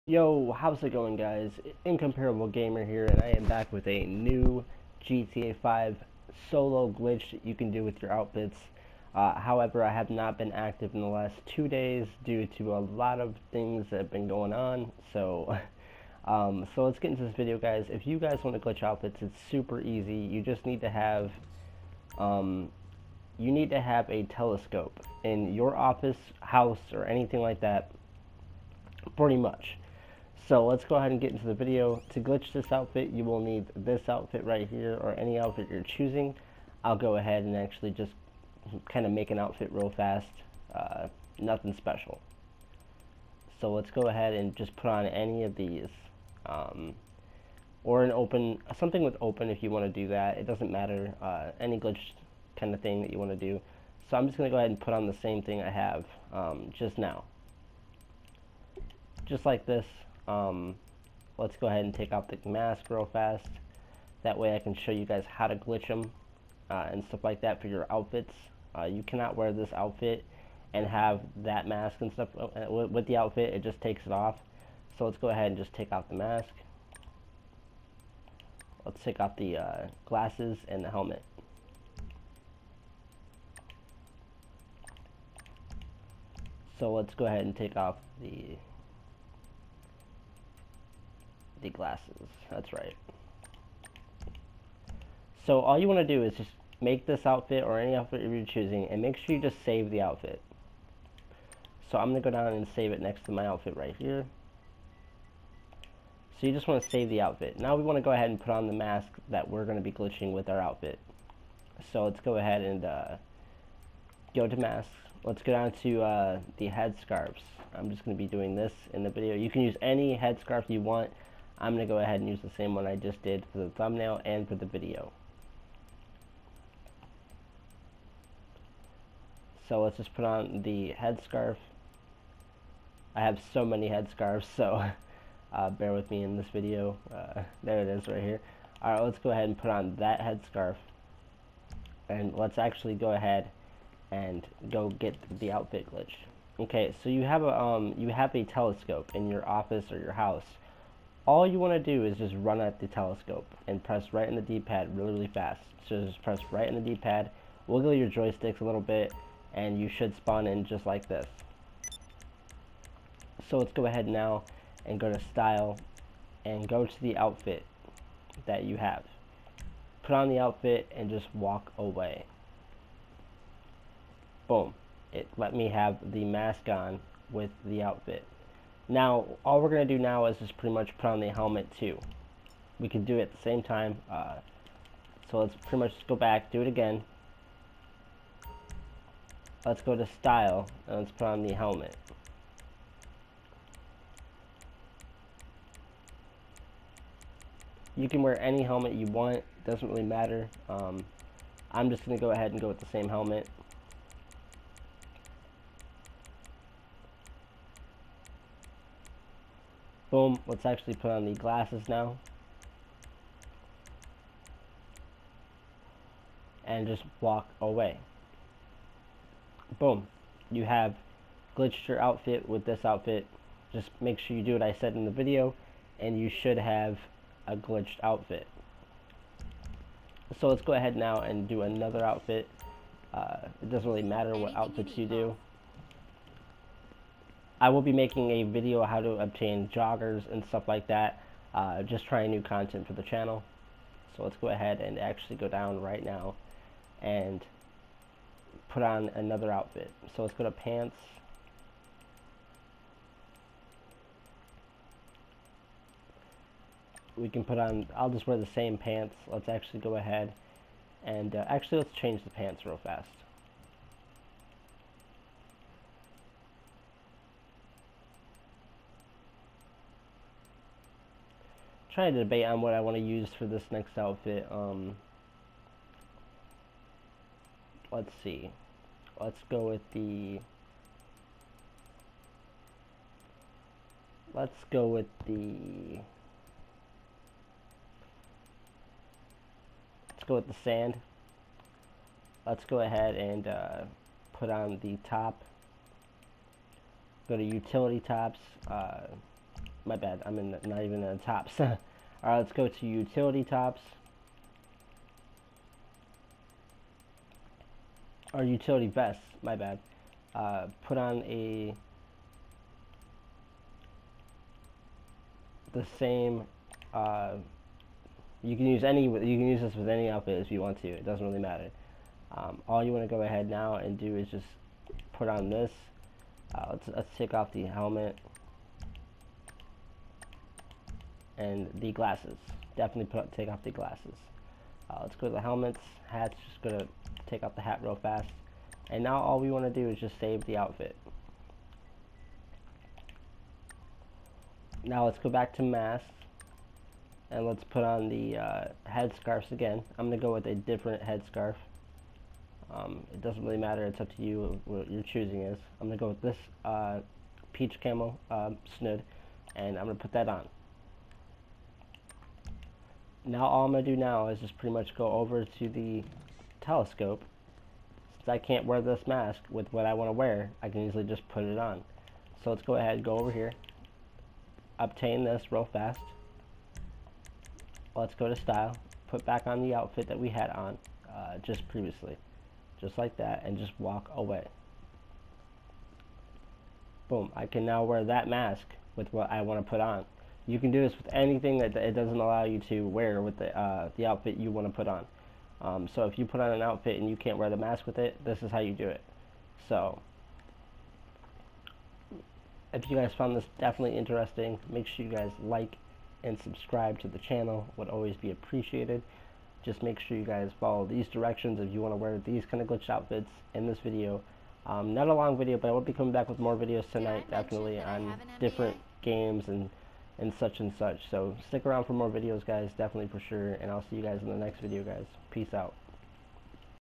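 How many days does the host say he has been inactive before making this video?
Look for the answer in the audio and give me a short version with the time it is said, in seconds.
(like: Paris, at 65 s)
2, at 11 s.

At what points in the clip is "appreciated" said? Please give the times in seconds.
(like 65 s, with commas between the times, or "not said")
408 s.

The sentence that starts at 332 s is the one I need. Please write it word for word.
Definitely put, take off the glasses.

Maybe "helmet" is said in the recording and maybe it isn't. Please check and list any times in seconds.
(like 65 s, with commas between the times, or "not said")
80 s, 181 s, 191 s, 198 s, 203 s, 327 s, 335 s.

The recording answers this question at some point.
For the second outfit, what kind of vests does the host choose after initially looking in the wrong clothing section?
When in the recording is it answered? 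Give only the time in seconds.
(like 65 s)
308 s.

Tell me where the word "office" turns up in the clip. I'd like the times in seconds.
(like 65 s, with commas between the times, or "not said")
25 s, 149 s.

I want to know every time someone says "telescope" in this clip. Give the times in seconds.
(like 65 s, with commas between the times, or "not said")
24 s, 148 s, 152 s, 366 s.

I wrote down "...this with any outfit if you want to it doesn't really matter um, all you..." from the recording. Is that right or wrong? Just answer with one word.
right.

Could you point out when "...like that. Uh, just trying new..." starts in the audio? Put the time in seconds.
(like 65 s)
240 s.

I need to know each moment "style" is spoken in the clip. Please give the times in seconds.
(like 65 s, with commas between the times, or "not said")
165 s, 190 s, 378 s.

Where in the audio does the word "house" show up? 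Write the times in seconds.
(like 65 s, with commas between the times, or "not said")
26 s, 150 s.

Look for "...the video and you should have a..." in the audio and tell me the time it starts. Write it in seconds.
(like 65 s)
225 s.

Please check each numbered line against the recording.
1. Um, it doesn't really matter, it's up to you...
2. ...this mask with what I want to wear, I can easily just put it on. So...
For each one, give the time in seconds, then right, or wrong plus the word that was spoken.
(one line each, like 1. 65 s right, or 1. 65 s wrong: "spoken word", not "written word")
1. 352 s right
2. 368 s right.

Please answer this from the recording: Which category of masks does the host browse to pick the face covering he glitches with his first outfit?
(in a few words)
Head scarves.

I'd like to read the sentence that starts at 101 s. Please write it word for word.
So I'm going to go down and save it next to my outfit right here.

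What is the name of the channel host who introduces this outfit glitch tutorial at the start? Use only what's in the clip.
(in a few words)
Incomparable Gamer.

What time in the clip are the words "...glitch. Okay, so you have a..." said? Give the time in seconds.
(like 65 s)
145 s.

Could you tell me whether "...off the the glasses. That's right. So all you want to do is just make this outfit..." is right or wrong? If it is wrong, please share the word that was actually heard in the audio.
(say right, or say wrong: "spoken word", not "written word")
right.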